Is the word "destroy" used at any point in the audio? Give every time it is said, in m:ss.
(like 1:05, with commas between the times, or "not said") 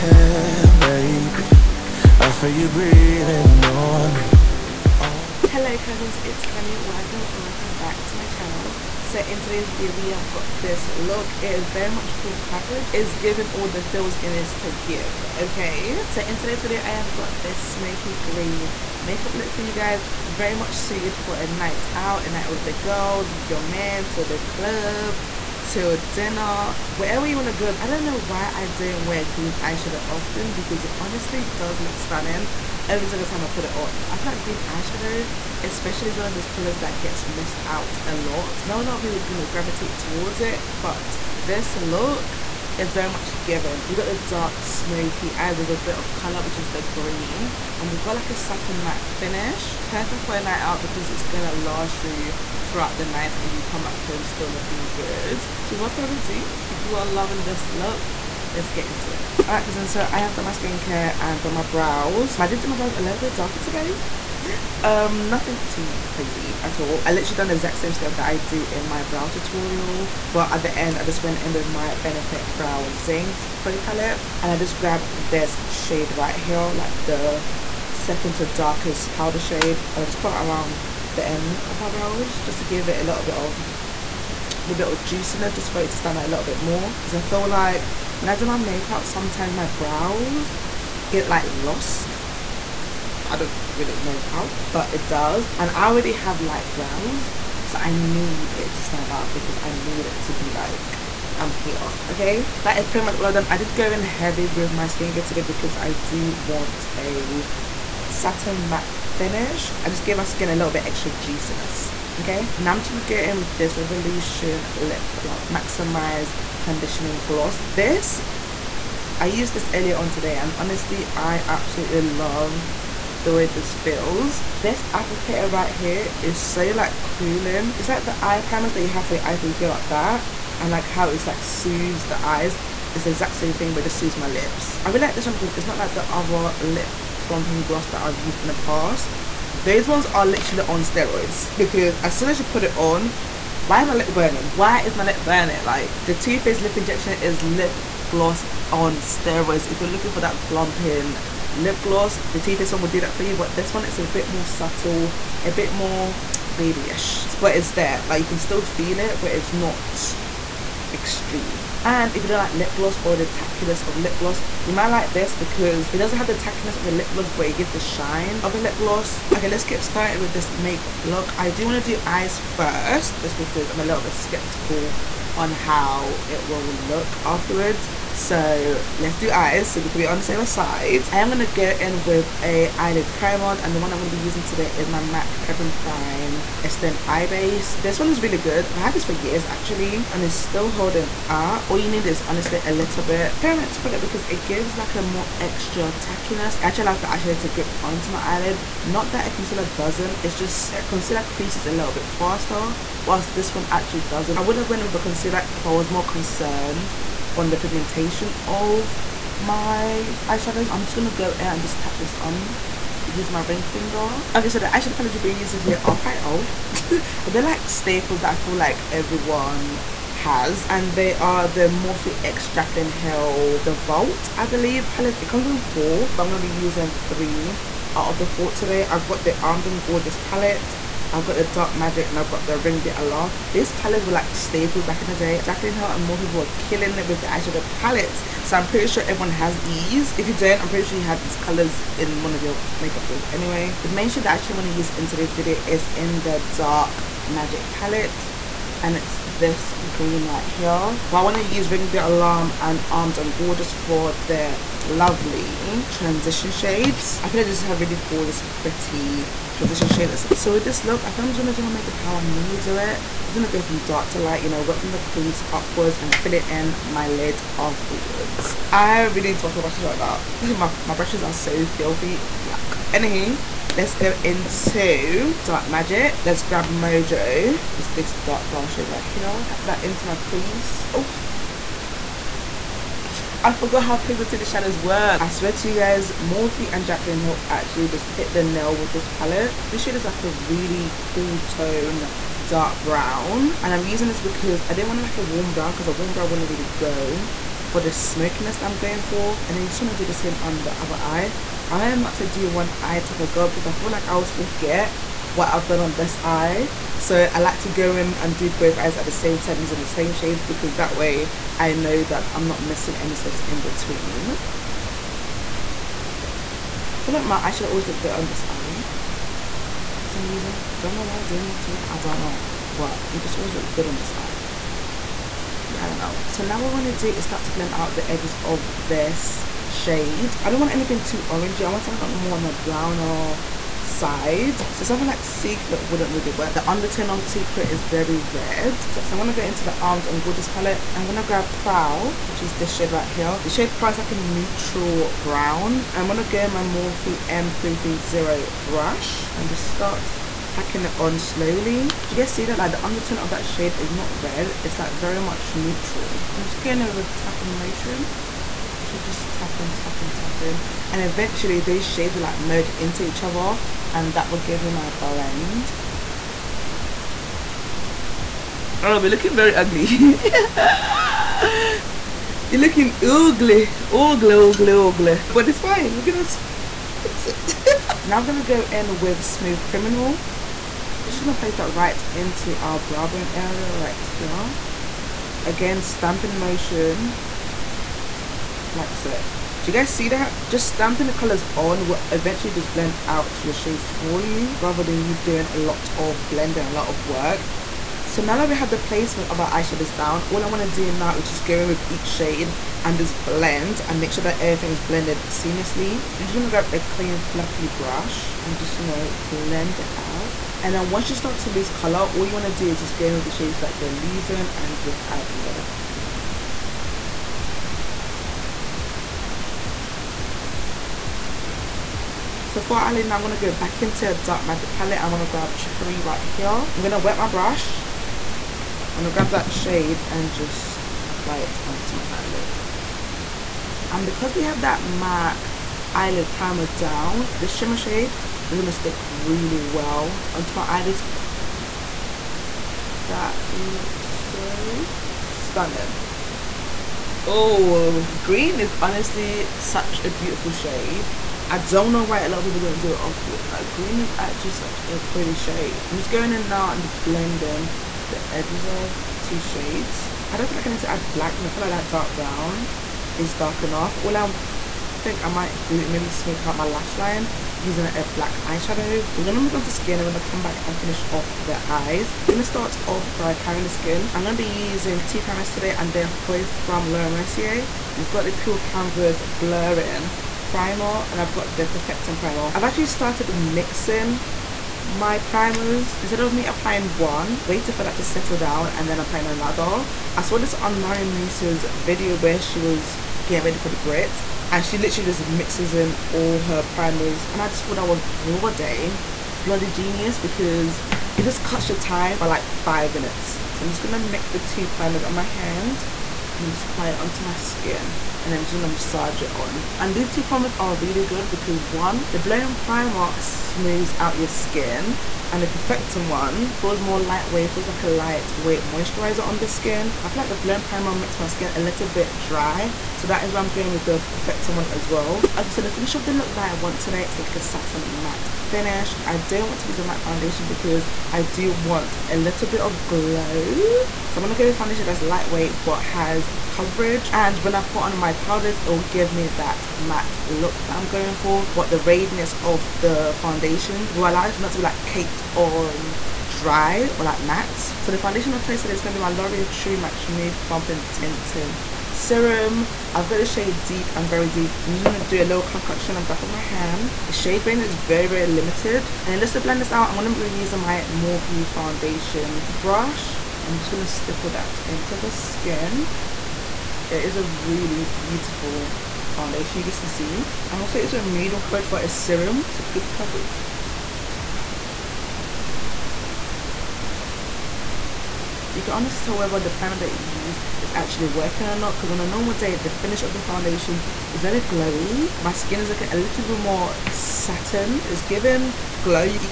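not said.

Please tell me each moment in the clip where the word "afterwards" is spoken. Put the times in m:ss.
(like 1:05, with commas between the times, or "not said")
2:57, 4:27.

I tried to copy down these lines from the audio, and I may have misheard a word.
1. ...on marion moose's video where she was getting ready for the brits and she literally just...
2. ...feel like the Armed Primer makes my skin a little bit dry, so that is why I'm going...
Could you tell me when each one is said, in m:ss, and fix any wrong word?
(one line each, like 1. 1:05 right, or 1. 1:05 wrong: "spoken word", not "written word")
1. 8:10 right
2. 8:40 wrong: "Blow", not "Armed".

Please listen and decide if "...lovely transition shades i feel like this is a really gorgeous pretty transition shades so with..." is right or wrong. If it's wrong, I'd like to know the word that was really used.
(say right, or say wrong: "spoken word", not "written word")
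right.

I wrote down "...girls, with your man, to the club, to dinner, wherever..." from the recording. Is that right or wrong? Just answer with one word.
right.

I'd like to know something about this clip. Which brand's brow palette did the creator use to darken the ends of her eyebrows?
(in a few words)
Benefit.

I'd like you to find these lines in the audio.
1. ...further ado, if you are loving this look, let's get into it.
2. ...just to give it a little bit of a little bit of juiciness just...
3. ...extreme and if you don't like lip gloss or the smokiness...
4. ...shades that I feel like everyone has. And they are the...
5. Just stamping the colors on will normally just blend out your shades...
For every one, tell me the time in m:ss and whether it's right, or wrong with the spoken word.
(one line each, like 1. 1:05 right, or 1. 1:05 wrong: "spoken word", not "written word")
1. 0:55 right
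2. 1:22 right
3. 2:40 wrong: "tackiness", not "smokiness"
4. 3:37 wrong: "staples", not "shades"
5. 6:30 wrong: "eventually", not "normally".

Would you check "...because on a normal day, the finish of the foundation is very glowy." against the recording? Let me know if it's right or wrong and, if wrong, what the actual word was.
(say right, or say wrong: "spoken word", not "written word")
right.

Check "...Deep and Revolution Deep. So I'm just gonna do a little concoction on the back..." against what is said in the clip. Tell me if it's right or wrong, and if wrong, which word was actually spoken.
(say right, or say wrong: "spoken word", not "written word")
wrong: "Very", not "Revolution".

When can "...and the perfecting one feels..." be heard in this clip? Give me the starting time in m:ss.
8:35.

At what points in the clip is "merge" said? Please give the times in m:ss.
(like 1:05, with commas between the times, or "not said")
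6:02.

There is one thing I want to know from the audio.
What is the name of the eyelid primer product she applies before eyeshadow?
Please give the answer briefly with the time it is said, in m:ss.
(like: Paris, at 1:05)
MAC Prep and Prime Extend Eye Base, at 3:04.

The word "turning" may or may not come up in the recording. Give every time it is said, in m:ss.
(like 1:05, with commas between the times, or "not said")
not said.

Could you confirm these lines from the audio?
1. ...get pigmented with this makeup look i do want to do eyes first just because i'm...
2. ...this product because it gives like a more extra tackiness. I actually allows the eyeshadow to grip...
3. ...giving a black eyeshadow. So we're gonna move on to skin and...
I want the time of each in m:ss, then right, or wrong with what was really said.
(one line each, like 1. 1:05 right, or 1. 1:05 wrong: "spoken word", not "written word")
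1. 2:49 wrong: "started", not "pigmented"
2. 3:13 right
3. 7:47 wrong: "using", not "giving".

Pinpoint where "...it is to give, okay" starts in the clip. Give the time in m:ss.
0:14.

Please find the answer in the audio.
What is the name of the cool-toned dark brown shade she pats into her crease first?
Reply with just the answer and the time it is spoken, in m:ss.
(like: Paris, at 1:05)
Mojo, at 4:36.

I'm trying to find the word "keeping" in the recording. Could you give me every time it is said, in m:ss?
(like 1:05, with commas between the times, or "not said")
not said.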